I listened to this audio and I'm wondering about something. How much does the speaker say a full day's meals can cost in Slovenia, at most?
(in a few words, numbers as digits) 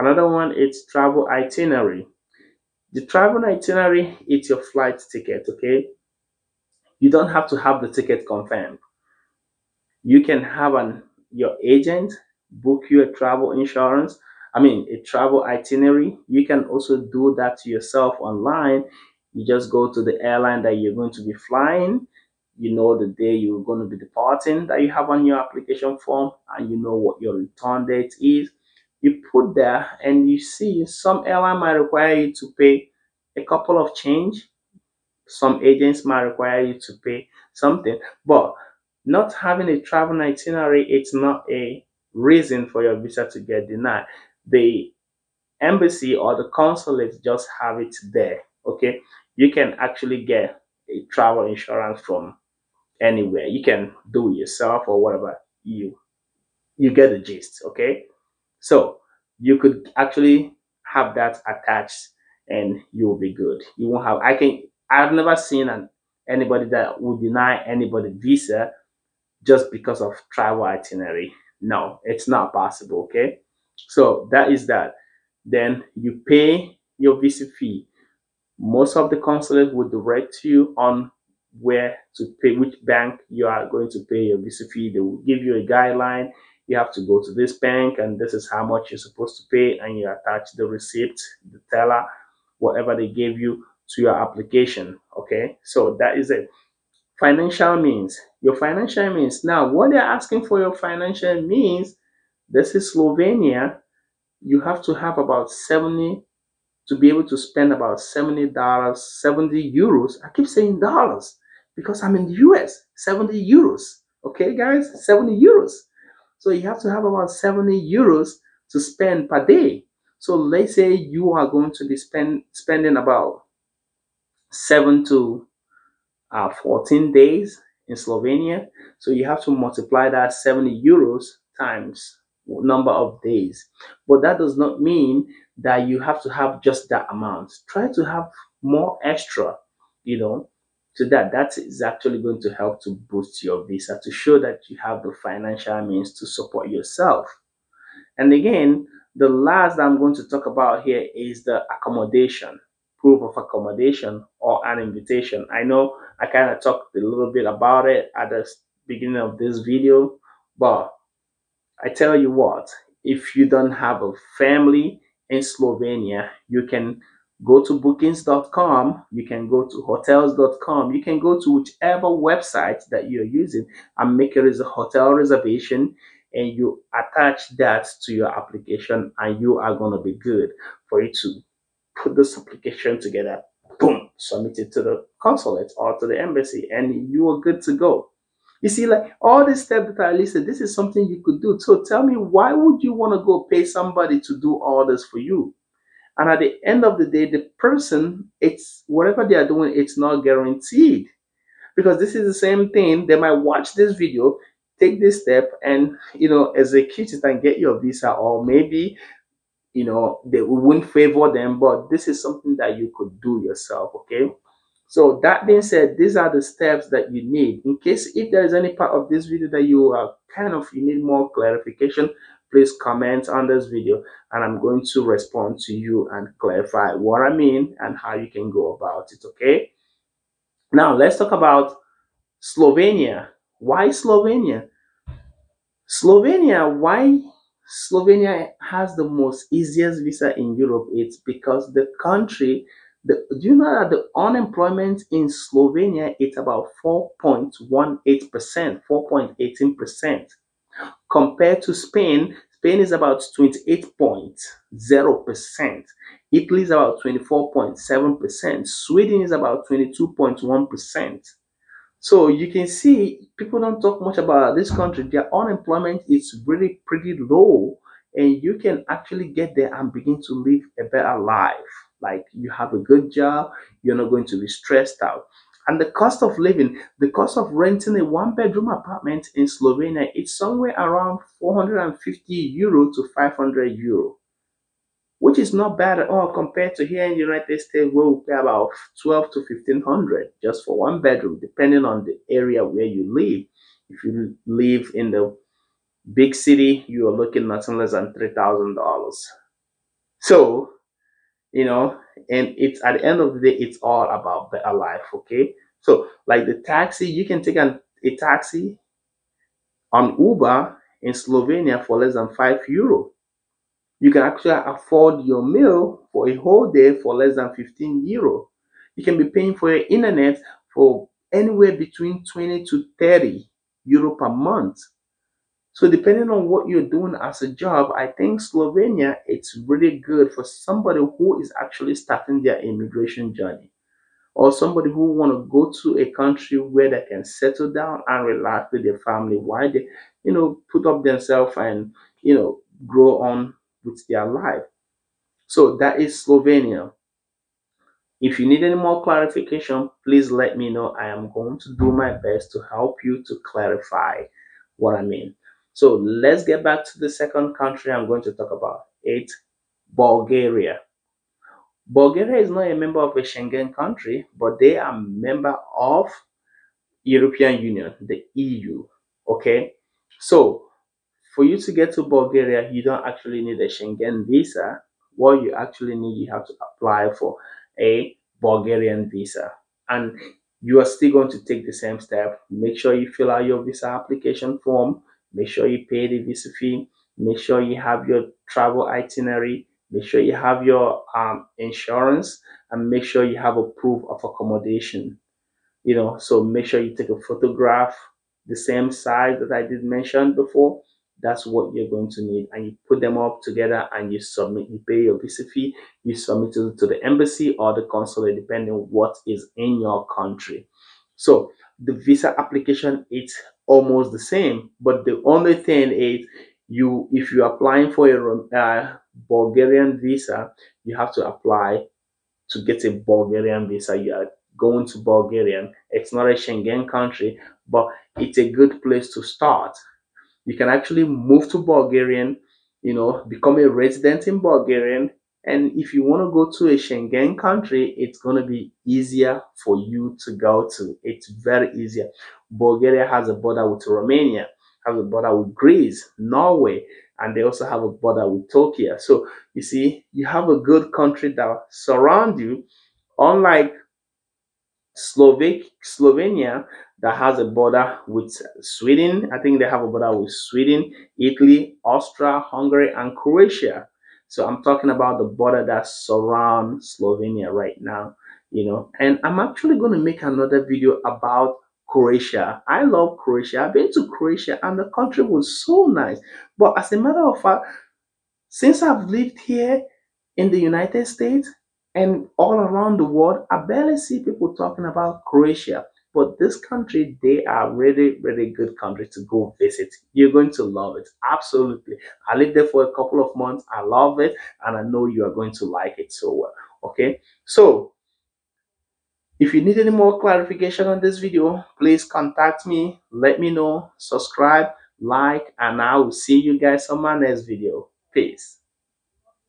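15 euros.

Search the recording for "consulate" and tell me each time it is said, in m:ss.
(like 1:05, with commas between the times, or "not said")
0:46, 1:19, 3:05, 6:47.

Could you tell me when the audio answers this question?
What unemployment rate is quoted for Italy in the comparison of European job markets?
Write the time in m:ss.
4:17.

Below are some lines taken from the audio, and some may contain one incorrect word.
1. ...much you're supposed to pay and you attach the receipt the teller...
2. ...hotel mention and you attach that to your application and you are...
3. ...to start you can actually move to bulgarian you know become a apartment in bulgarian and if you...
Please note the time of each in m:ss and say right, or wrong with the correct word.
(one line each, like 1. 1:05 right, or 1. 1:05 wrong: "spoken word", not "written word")
1. 1:28 right
2. 2:54 wrong: "reservation", not "mention"
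3. 7:09 wrong: "resident", not "apartment".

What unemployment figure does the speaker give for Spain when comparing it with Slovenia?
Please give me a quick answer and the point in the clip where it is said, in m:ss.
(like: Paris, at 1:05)
28.0%, at 4:13.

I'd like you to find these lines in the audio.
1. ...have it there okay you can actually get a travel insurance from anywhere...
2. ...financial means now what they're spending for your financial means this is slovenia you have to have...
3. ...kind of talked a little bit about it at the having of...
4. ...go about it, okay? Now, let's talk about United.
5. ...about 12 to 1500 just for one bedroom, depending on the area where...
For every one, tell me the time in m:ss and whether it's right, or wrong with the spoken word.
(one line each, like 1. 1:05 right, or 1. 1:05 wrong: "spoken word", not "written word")
1. 0:47 right
2. 1:38 wrong: "asking", not "spending"
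3. 2:36 wrong: "beginning", not "having"
4. 3:48 wrong: "Slovenia", not "United"
5. 4:48 right.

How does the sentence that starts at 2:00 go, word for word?
So let's say you are going to be spend, spending about 7 to uh, 14 days in Slovenia.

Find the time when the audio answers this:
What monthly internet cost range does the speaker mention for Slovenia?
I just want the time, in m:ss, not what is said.
5:22.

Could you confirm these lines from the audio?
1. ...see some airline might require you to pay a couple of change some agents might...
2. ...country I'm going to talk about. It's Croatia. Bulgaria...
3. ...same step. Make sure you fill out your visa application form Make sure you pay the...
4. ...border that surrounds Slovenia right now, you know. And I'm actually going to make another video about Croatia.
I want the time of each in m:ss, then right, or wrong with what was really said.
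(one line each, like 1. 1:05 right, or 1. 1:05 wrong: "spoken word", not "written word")
1. 0:30 right
2. 5:57 wrong: "Bulgaria", not "Croatia"
3. 6:21 right
4. 7:45 right.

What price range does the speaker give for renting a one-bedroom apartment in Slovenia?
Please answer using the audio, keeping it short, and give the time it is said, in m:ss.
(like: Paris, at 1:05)
450 to 500 euros, at 4:41.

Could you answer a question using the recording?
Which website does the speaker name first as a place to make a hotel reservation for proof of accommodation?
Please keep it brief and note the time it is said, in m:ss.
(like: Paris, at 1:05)
bookings.com, at 2:47.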